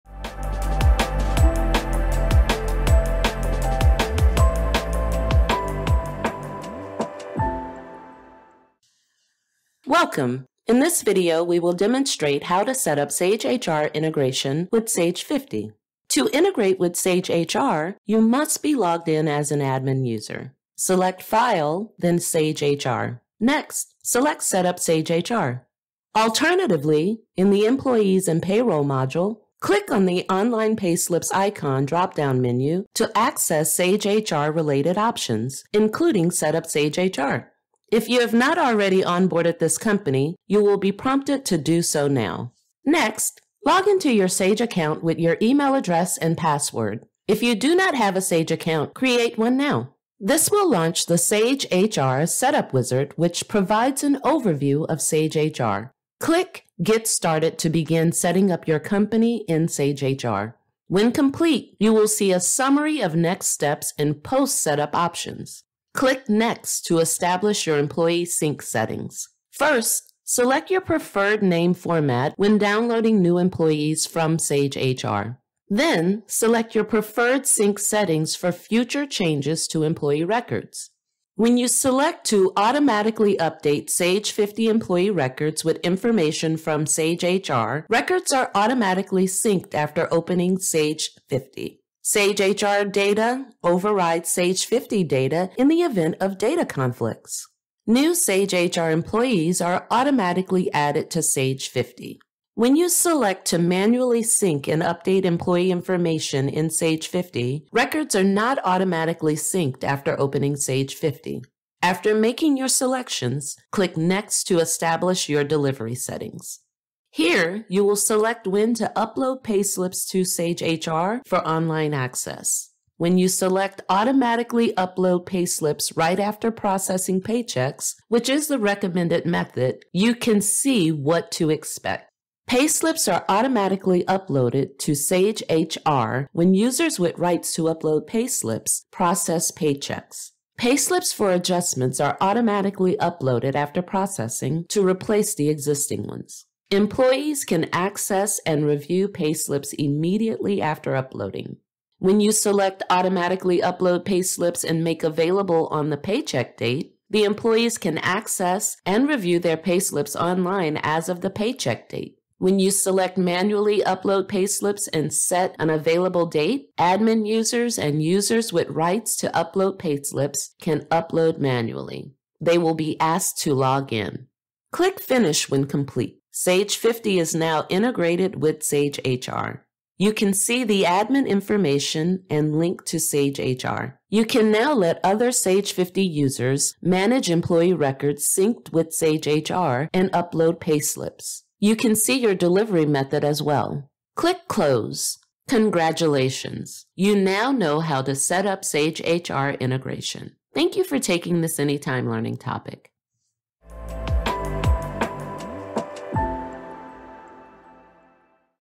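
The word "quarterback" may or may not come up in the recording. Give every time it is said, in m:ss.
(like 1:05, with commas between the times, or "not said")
not said.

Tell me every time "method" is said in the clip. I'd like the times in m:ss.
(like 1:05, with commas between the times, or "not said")
2:09, 3:12.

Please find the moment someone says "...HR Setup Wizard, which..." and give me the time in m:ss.
0:51.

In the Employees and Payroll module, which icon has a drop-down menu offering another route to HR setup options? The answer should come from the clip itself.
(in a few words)
Online Payslips.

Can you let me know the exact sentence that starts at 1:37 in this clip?
New Sage HR employees are automatically added to Sage 50.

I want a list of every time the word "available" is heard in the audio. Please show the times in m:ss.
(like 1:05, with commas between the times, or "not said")
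2:35, 2:45.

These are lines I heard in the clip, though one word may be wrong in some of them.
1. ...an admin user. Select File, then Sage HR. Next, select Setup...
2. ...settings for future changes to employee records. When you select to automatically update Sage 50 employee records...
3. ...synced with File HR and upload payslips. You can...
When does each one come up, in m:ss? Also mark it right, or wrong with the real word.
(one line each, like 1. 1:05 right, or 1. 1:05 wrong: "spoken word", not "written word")
1. 0:19 right
2. 1:17 right
3. 3:08 wrong: "Sage", not "File".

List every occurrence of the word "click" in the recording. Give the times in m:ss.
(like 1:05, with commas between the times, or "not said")
0:29, 0:56, 1:05, 1:53, 2:54, 3:14.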